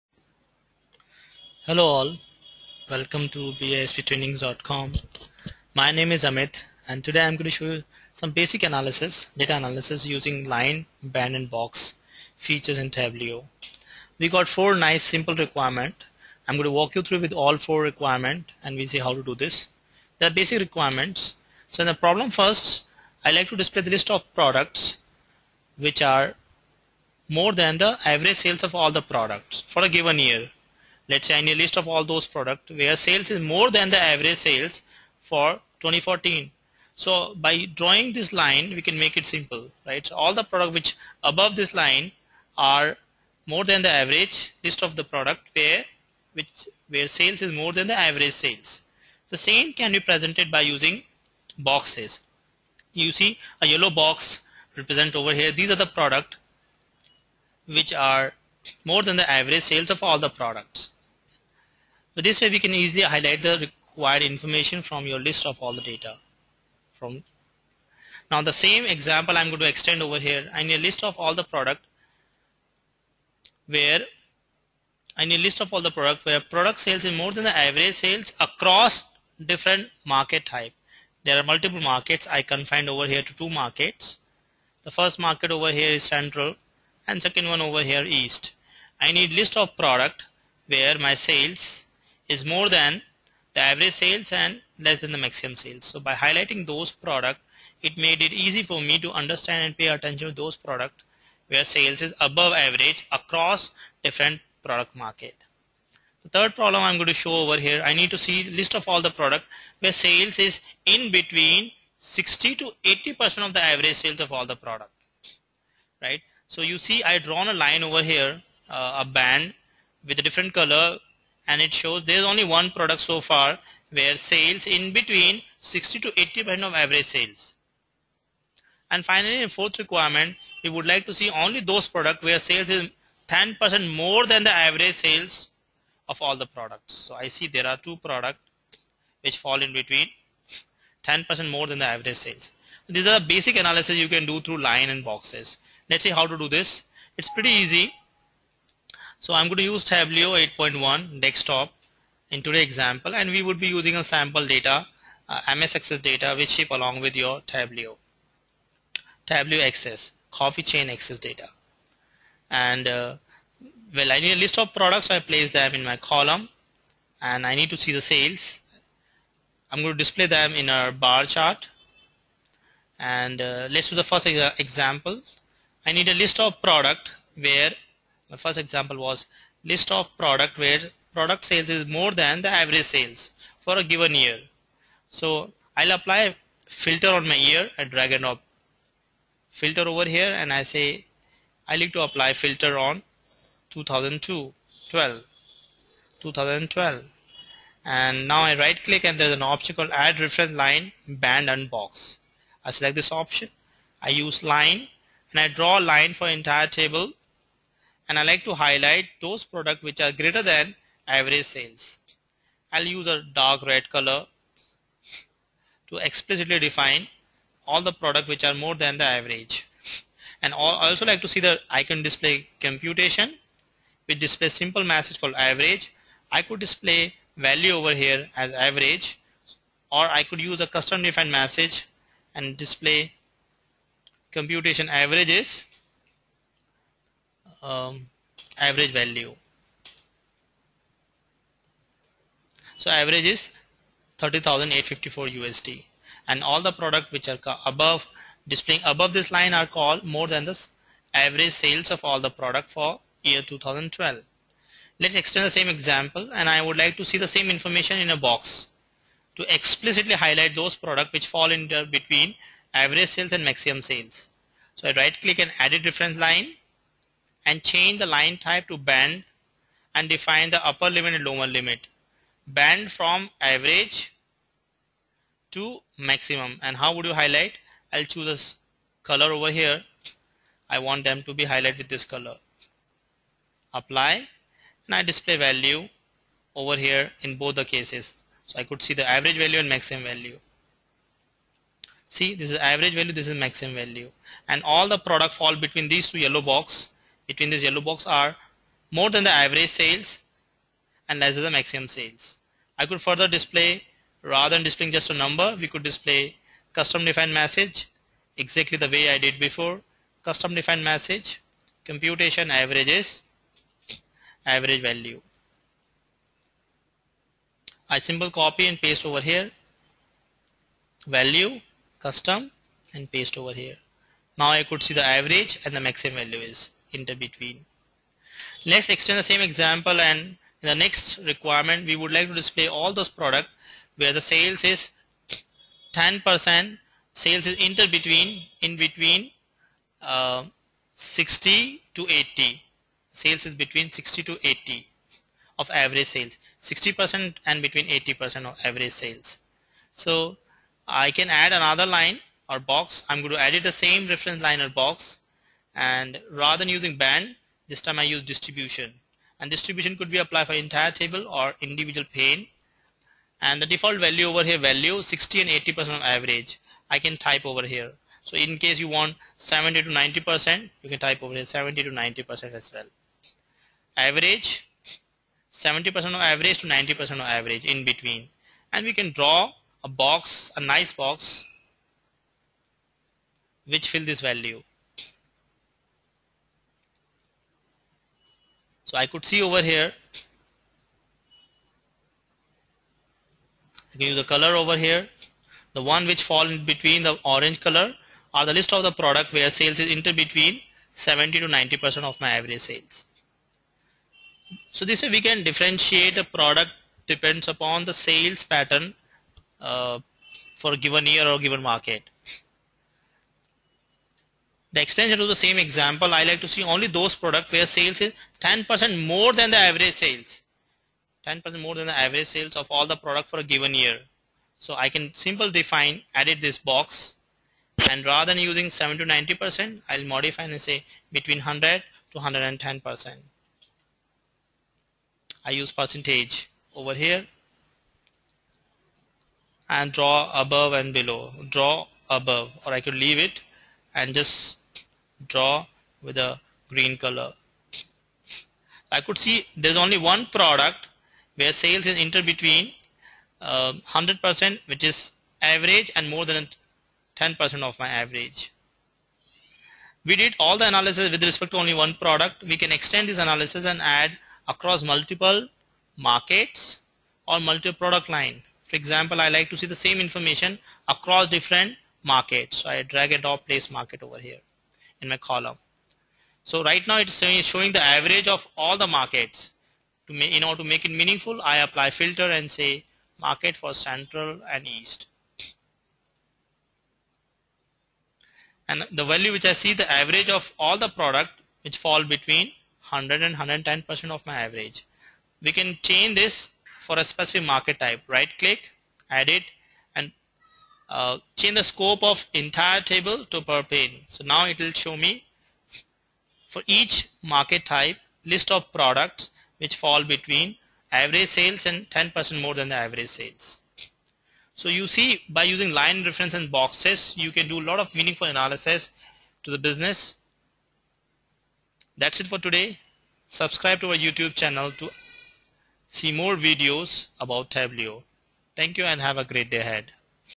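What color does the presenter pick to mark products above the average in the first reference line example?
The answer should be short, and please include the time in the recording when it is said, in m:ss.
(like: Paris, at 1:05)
dark red, at 3:33.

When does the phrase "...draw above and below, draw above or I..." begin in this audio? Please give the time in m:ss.
7:19.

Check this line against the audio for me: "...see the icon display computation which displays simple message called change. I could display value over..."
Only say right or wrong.
wrong.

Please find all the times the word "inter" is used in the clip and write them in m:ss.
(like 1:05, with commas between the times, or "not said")
5:37, 6:39, 7:31.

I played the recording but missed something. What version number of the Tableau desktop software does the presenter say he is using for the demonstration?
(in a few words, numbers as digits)
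8.1.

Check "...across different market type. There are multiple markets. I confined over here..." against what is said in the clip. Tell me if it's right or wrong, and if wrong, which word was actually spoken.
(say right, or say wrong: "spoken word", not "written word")
right.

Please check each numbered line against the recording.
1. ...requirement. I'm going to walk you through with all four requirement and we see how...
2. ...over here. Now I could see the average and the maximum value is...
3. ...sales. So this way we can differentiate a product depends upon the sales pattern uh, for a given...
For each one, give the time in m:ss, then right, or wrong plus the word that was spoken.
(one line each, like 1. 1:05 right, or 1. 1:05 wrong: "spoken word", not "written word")
1. 0:15 right
2. 5:23 right
3. 6:42 right.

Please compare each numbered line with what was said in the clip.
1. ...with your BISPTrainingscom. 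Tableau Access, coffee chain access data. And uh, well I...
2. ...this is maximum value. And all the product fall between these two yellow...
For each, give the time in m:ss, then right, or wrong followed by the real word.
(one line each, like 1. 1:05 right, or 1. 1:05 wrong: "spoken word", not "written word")
1. 2:37 wrong: "Tableau", not "BISPTrainingscom"
2. 4:53 right.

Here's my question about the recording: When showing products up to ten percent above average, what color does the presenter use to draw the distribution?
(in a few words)
green.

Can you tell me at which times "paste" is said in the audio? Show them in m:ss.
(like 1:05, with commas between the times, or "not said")
5:18, 5:23.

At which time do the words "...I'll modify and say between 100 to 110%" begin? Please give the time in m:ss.
7:09.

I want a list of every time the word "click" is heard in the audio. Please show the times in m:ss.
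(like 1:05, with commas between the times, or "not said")
3:18, 4:25, 8:18.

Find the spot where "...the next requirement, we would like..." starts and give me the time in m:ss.
5:30.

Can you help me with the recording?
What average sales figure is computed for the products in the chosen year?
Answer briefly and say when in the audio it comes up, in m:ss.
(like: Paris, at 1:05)
30,854 USD, at 4:04.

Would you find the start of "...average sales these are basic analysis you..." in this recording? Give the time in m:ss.
2:21.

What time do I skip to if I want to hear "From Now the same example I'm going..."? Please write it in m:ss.
1:06.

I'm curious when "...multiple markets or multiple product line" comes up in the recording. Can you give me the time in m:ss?
7:44.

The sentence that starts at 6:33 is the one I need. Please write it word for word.
I can the color over here.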